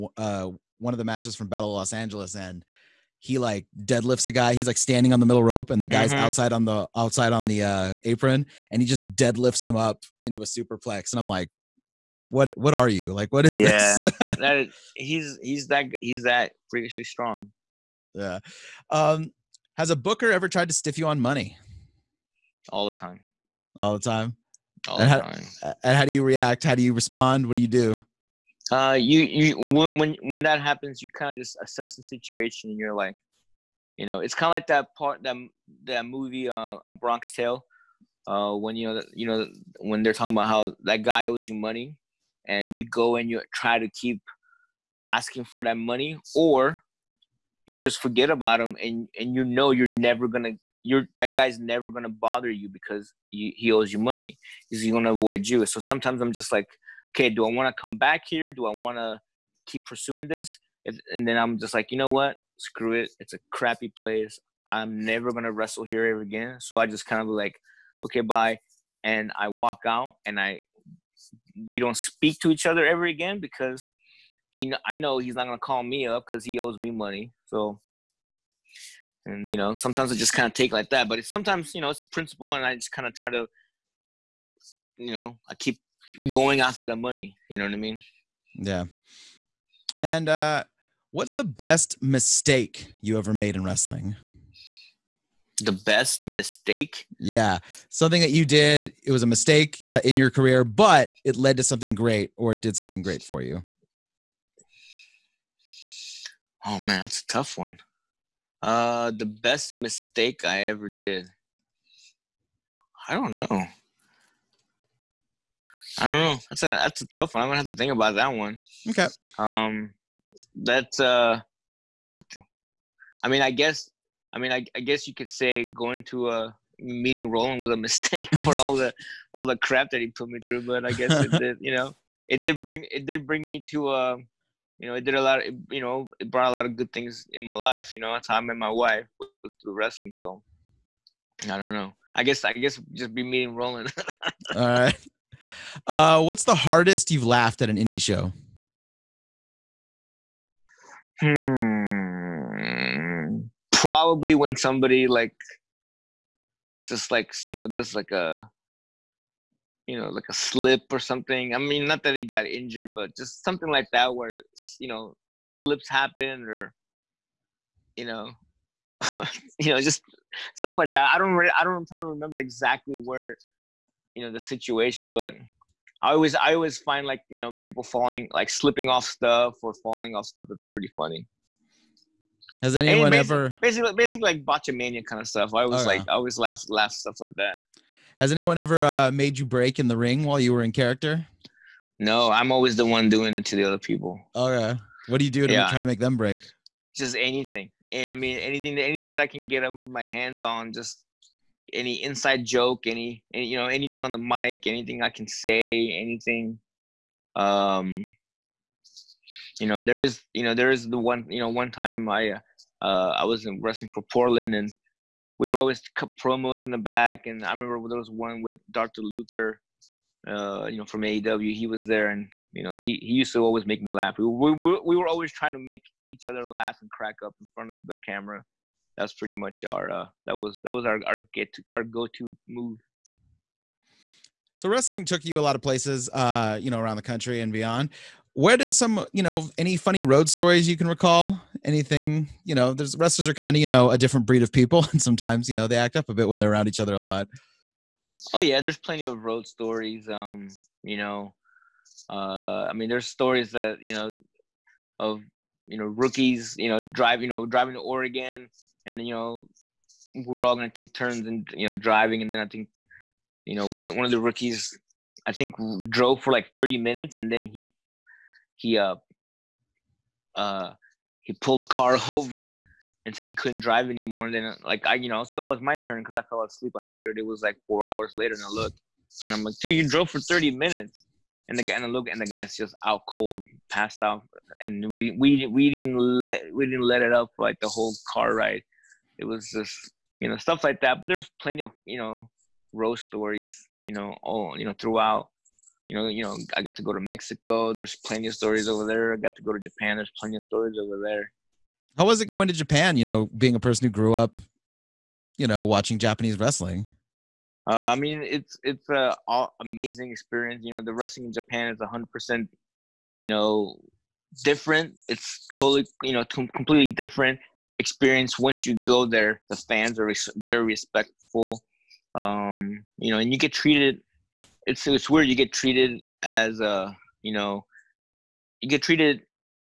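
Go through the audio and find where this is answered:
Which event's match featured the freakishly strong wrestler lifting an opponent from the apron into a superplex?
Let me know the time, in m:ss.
0:01.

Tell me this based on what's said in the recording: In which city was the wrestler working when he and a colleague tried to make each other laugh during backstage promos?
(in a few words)
Portland.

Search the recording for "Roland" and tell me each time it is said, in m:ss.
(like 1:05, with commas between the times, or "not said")
2:07, 2:23.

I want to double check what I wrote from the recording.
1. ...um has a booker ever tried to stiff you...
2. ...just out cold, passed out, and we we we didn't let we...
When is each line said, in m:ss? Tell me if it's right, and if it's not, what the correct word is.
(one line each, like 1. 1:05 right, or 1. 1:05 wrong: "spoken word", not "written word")
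1. 0:18 right
2. 4:42 right.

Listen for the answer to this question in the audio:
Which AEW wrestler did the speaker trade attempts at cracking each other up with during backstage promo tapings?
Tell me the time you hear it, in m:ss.
3:38.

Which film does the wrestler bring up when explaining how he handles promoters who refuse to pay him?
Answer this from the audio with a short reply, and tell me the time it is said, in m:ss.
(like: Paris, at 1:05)
A Bronx Tale, at 0:36.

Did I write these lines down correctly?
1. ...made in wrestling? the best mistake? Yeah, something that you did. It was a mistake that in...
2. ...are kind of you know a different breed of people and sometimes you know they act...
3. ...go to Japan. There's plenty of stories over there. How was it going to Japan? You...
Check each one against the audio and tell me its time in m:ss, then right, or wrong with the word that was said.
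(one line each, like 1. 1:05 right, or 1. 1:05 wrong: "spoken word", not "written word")
1. 1:33 right
2. 4:03 right
3. 4:59 right.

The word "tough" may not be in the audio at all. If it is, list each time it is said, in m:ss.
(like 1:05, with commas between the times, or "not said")
1:47, 1:57.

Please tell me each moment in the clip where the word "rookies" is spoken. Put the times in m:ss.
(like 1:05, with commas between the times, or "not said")
4:15, 4:24.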